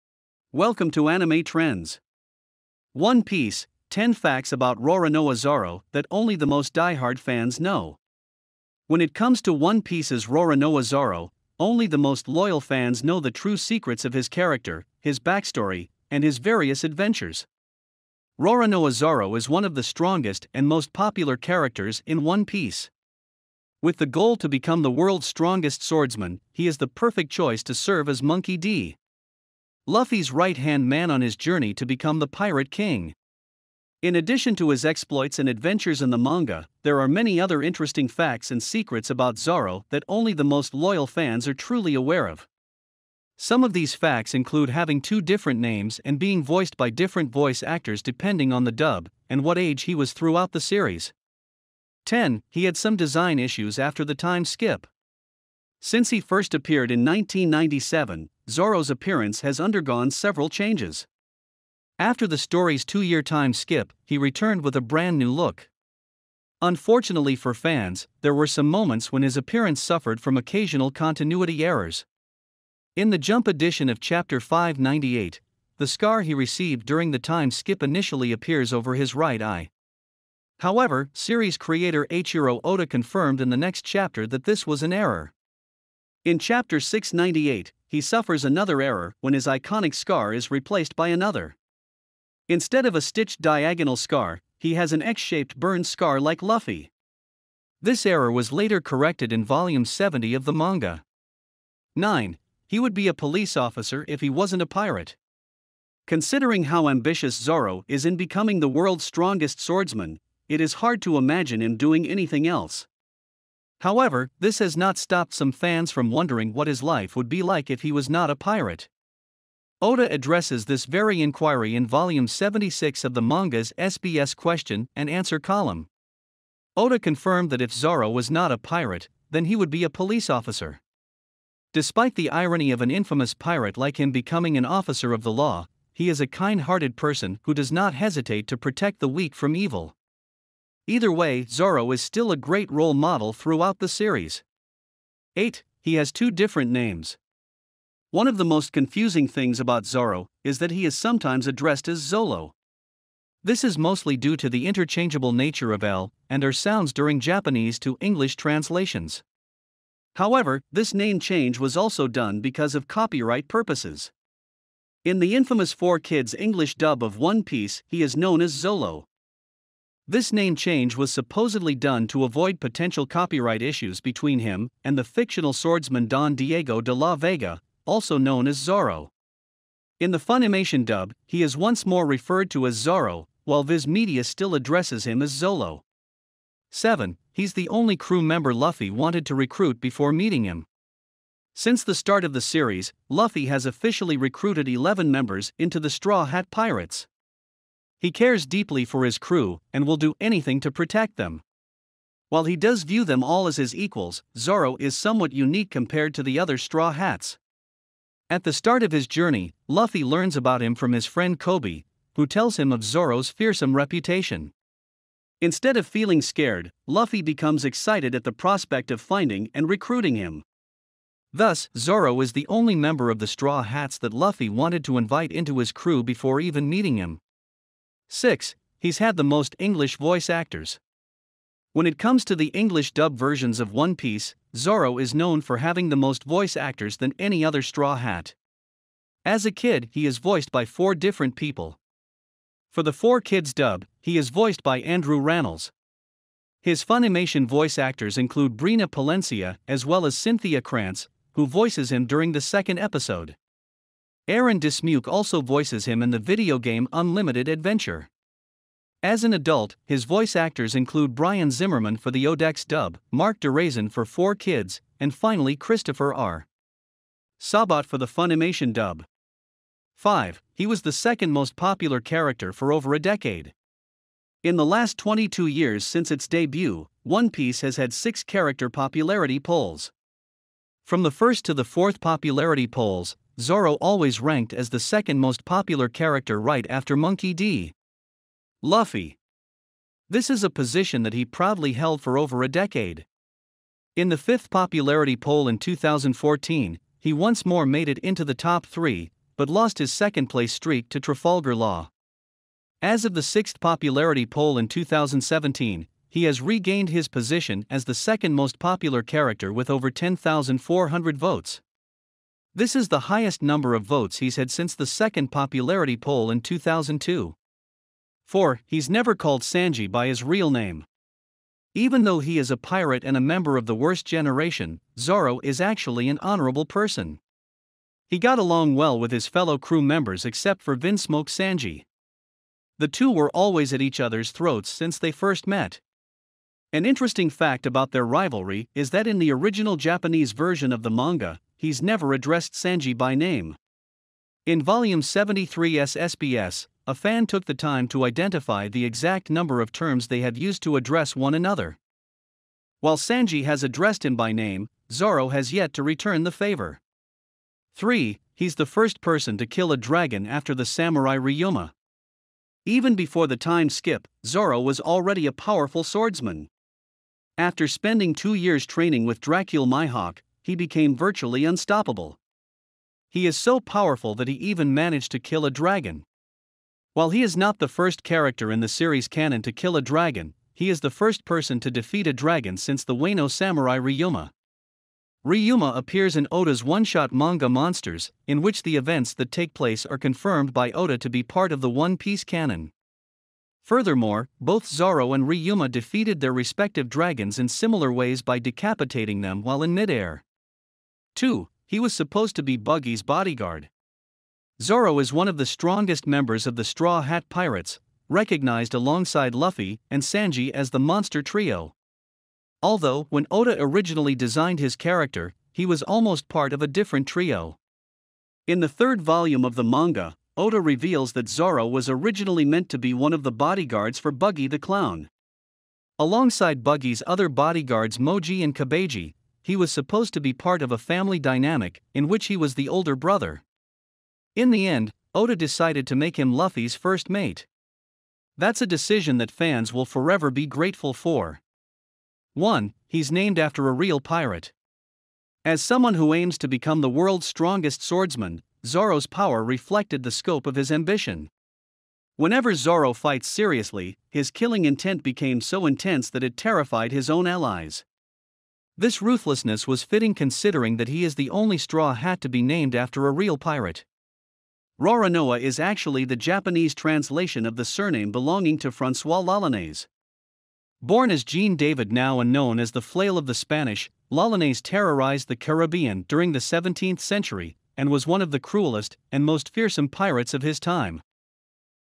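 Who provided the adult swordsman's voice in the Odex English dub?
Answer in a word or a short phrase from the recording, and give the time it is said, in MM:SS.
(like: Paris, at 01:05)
Brian Zimmerman, at 04:21.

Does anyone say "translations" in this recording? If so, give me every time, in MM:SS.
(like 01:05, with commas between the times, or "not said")
02:38, 07:46.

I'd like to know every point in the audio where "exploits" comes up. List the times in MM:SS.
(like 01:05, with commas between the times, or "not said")
00:34.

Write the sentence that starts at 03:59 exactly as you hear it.
As a kid, he is voiced by four different people.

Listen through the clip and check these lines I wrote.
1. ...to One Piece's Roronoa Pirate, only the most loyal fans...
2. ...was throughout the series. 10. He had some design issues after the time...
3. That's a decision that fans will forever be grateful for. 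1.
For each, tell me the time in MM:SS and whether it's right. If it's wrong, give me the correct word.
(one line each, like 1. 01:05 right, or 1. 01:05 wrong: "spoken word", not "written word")
1. 00:09 wrong: "Zoro", not "Pirate"
2. 00:49 right
3. 07:18 right.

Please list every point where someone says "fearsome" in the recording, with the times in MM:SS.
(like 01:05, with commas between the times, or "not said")
03:33, 07:59.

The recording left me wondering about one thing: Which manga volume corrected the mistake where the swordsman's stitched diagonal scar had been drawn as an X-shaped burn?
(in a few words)
Volume 70.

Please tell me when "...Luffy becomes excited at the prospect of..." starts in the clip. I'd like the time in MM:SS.
03:36.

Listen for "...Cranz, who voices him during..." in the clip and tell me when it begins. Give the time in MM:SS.
04:10.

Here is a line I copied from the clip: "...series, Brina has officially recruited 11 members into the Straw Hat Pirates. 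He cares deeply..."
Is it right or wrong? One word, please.
wrong.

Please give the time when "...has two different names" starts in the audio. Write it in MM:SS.
02:25.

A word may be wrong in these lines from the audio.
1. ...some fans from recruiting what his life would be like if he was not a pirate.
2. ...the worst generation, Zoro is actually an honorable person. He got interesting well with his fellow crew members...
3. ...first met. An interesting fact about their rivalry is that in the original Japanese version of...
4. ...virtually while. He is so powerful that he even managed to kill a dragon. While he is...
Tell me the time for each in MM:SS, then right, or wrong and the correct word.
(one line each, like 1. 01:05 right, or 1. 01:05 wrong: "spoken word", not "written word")
1. 01:55 wrong: "wondering", not "recruiting"
2. 05:23 wrong: "along", not "interesting"
3. 05:35 right
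4. 06:10 wrong: "unstoppable", not "while".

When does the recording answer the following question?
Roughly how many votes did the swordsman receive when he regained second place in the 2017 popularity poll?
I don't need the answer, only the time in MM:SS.
05:09.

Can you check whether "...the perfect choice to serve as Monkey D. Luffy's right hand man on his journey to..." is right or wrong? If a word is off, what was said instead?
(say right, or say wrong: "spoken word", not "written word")
right.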